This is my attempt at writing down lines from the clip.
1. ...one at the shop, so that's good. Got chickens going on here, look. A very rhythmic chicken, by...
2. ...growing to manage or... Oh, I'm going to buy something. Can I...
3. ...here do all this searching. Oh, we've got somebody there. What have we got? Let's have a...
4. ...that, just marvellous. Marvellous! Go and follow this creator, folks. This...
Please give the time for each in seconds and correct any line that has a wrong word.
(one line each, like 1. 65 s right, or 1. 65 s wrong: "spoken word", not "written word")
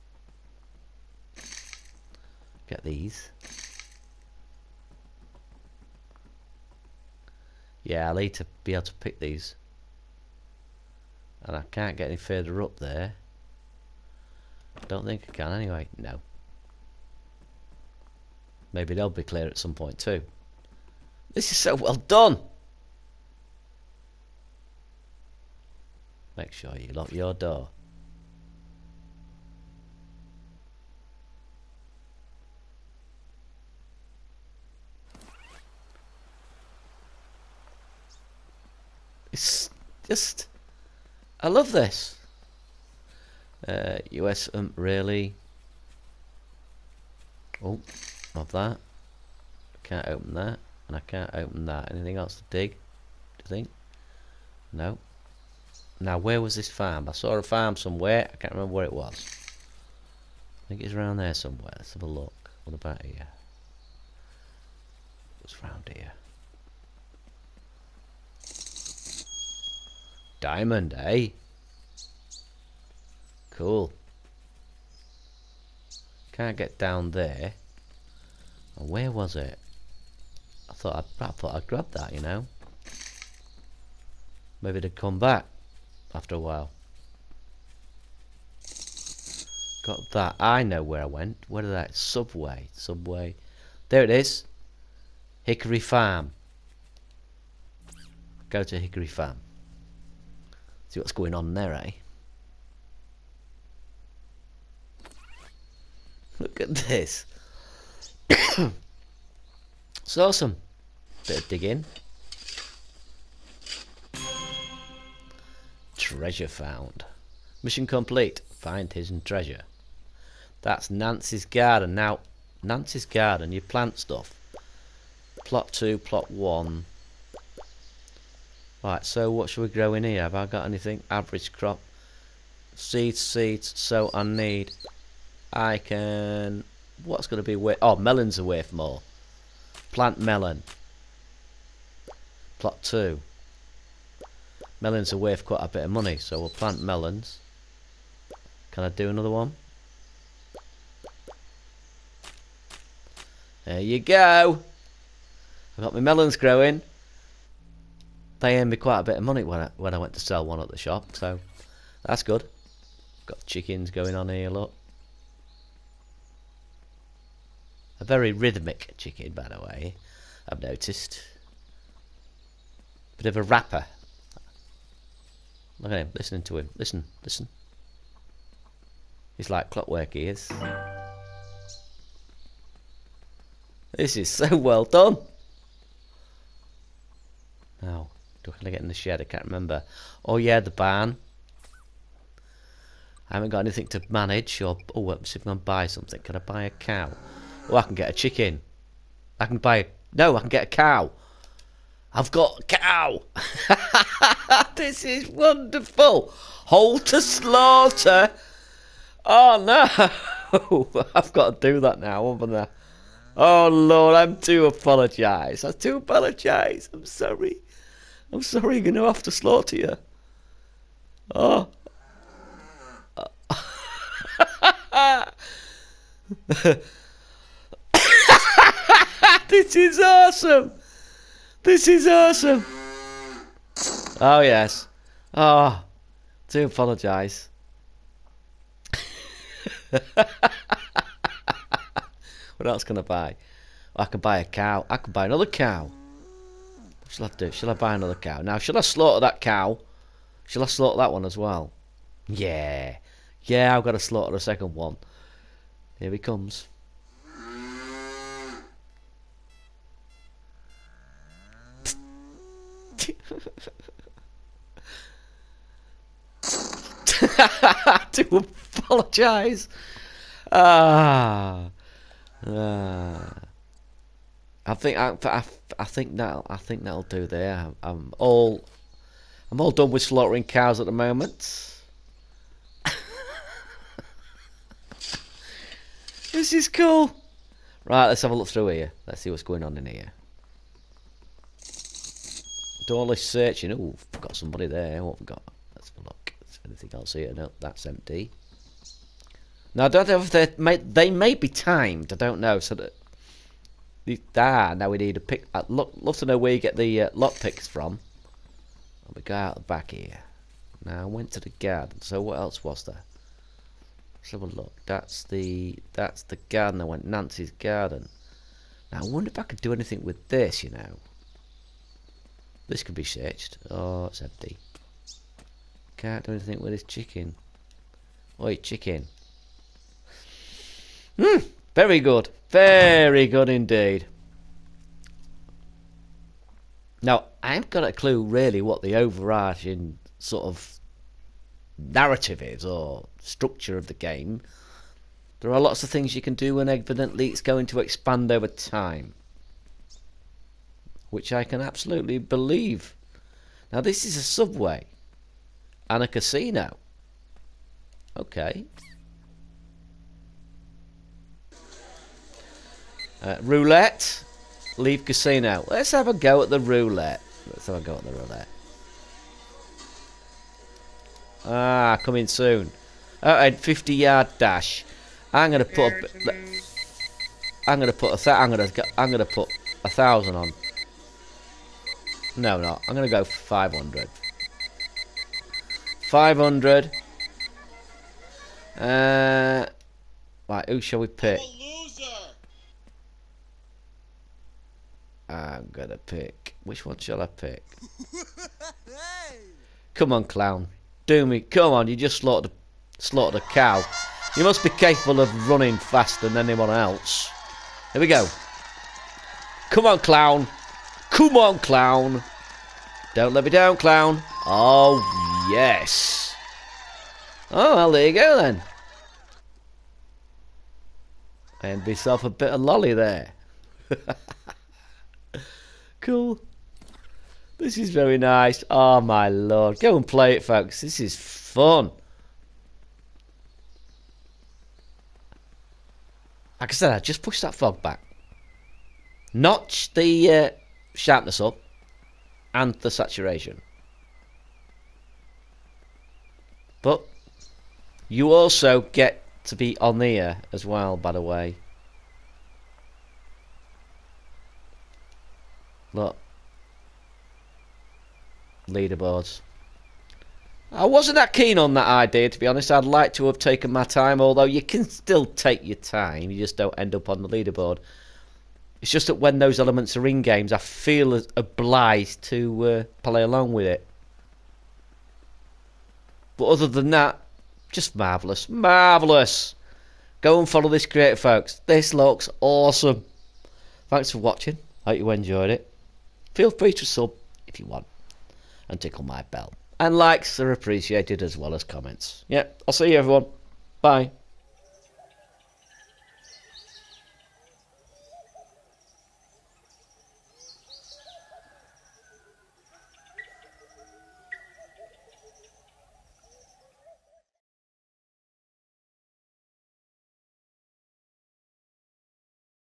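1. 160 s right
2. 193 s wrong: "anything", not "growing"
3. 289 s right
4. 476 s right.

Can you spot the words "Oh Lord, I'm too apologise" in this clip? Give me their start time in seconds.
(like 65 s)
213 s.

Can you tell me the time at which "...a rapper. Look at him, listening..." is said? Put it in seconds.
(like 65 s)
173 s.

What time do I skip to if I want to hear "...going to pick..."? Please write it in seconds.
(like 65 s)
395 s.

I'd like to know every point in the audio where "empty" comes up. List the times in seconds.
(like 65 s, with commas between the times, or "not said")
297 s, 324 s.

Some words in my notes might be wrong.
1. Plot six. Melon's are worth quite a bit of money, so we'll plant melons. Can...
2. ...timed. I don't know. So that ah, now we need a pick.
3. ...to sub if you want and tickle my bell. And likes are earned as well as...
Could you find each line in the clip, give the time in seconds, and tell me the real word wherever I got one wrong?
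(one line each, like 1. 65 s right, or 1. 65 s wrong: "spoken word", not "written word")
1. 142 s wrong: "two", not "six"
2. 301 s right
3. 486 s wrong: "appreciated", not "earned".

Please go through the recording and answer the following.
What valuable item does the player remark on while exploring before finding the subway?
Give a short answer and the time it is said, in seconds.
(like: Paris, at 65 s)
Diamond, at 70 s.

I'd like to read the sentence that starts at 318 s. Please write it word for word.
Now I wonder if I could do anything with this.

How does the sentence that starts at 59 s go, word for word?
I think it's around there somewhere.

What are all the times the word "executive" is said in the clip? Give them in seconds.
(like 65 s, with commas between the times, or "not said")
not said.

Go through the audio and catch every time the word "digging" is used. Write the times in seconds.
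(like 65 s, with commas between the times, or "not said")
111 s.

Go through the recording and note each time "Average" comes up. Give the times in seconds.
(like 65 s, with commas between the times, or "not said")
131 s.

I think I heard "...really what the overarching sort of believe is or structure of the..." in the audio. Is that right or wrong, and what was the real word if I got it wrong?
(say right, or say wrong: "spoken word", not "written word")
wrong: "narrative", not "believe".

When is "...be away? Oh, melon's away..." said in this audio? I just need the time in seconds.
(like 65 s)
137 s.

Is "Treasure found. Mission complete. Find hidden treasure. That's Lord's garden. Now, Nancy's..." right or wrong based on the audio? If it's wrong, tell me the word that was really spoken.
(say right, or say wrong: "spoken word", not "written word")
wrong: "Nancy", not "Lord".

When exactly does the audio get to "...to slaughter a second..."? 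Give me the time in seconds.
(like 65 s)
253 s.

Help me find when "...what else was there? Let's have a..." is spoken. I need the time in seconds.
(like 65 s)
312 s.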